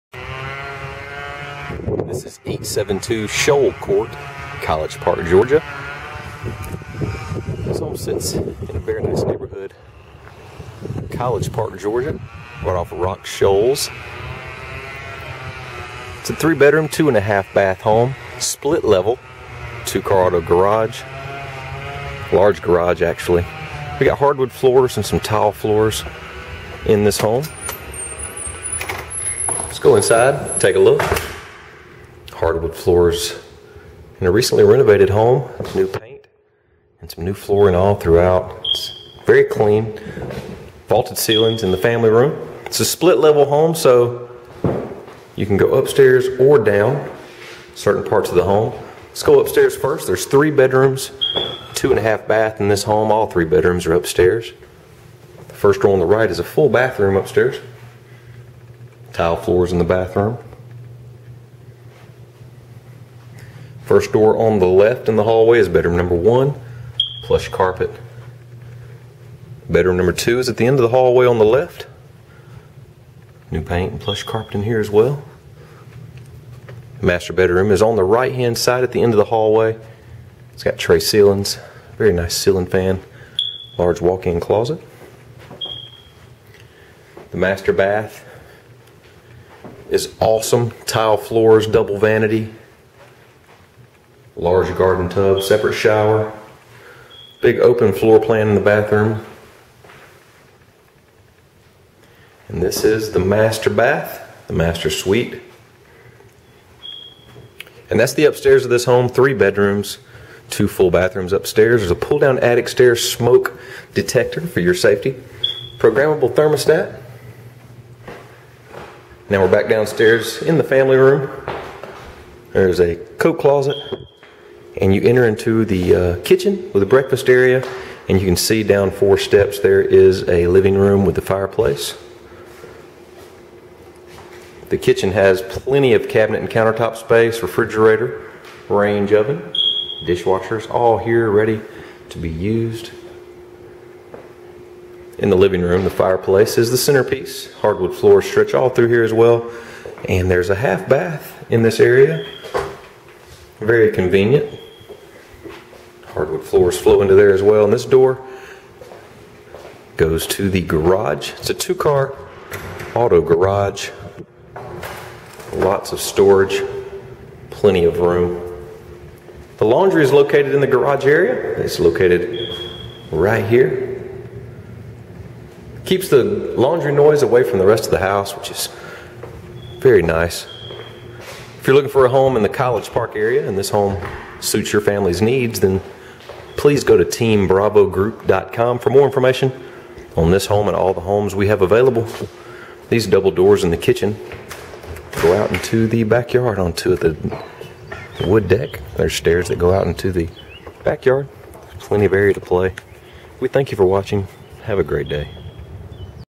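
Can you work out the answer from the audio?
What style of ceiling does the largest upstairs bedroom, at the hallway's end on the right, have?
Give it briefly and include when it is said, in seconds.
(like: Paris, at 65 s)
Tray ceilings, at 80 s.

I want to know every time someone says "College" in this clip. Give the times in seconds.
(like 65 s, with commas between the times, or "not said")
4 s, 11 s, 182 s.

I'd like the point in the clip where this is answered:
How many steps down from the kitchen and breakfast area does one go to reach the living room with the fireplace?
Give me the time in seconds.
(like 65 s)
128 s.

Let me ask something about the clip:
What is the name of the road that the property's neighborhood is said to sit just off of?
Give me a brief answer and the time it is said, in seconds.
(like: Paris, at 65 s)
Rock Shoals, at 12 s.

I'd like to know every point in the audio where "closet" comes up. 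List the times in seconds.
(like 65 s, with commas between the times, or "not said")
84 s, 123 s.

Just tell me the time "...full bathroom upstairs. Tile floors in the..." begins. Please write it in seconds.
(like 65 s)
56 s.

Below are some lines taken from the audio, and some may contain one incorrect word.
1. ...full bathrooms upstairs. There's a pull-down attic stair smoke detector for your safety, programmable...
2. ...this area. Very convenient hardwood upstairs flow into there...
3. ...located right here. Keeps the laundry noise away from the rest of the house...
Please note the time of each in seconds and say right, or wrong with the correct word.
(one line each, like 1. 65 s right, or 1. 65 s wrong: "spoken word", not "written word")
1. 110 s right
2. 151 s wrong: "floors", not "upstairs"
3. 171 s right.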